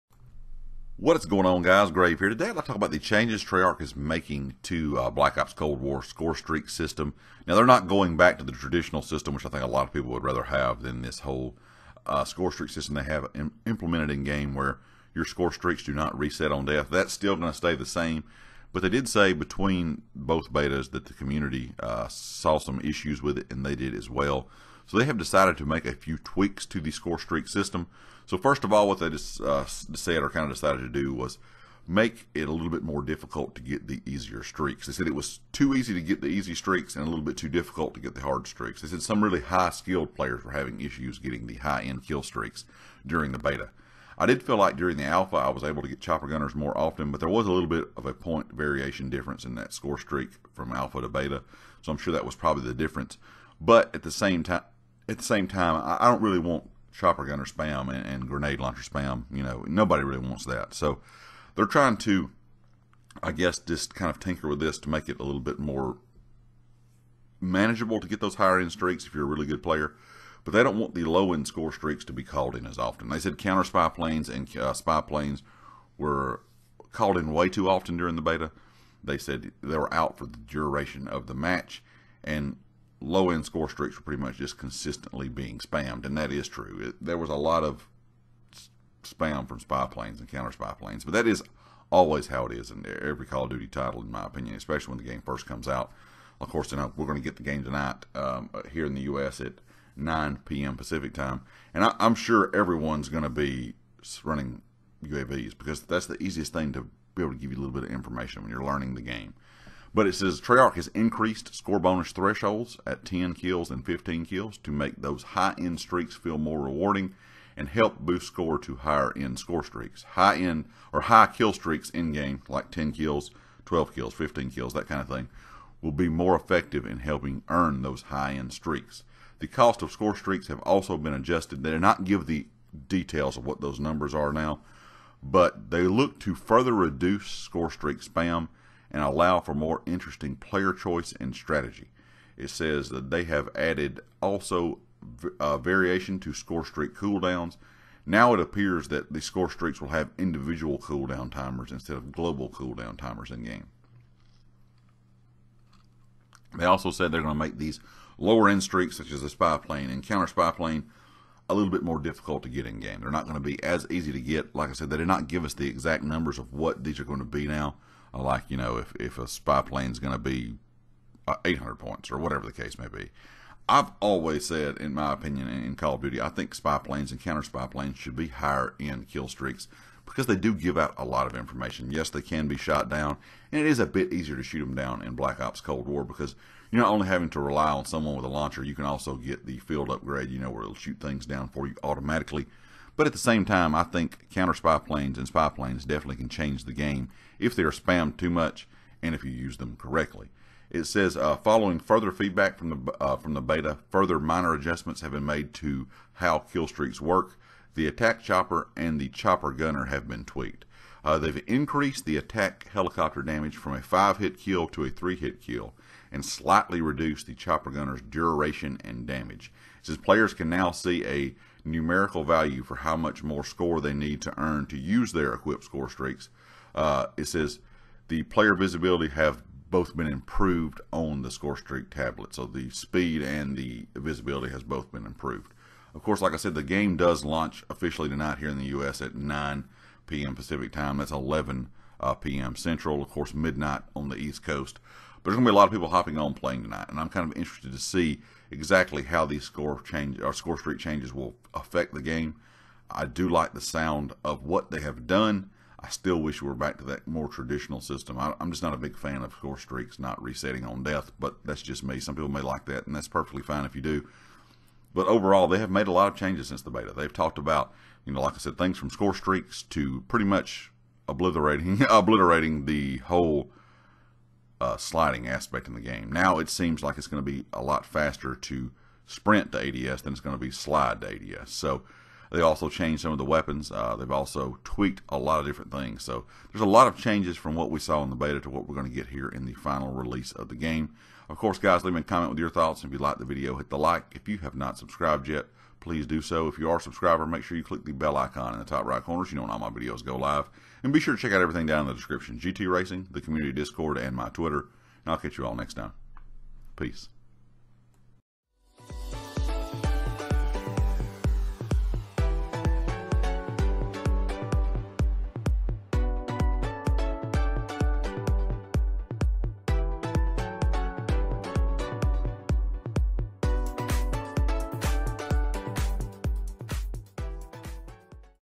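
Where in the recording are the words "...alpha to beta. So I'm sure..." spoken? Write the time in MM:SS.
00:50.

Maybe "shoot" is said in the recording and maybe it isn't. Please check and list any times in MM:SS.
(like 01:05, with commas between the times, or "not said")
03:04, 03:10.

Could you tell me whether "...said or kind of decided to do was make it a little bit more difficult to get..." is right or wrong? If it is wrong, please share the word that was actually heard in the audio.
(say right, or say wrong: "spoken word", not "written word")
right.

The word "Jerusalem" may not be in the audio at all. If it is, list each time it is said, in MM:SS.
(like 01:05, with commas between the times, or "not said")
not said.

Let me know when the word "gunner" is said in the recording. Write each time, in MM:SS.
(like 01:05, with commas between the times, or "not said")
00:46, 00:57, 03:29, 03:37.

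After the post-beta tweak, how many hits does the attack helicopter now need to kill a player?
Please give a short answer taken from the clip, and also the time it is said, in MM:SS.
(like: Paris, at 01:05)
3, at 03:34.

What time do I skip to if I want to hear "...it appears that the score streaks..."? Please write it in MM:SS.
02:28.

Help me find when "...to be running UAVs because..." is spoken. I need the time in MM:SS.
01:43.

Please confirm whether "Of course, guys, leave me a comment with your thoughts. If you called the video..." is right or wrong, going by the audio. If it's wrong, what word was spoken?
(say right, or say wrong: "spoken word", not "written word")
wrong: "liked", not "called".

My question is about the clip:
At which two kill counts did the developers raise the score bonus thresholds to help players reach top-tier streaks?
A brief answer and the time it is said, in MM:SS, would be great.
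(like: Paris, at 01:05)
10 and 15 kills, at 01:53.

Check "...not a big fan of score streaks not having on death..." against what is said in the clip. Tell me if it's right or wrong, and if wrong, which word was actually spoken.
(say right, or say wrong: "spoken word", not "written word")
wrong: "resetting", not "having".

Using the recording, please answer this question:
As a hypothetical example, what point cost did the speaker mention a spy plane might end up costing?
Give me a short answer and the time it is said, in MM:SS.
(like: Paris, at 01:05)
800 points, at 02:51.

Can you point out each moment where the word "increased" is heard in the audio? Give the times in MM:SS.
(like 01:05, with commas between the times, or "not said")
01:50, 03:31.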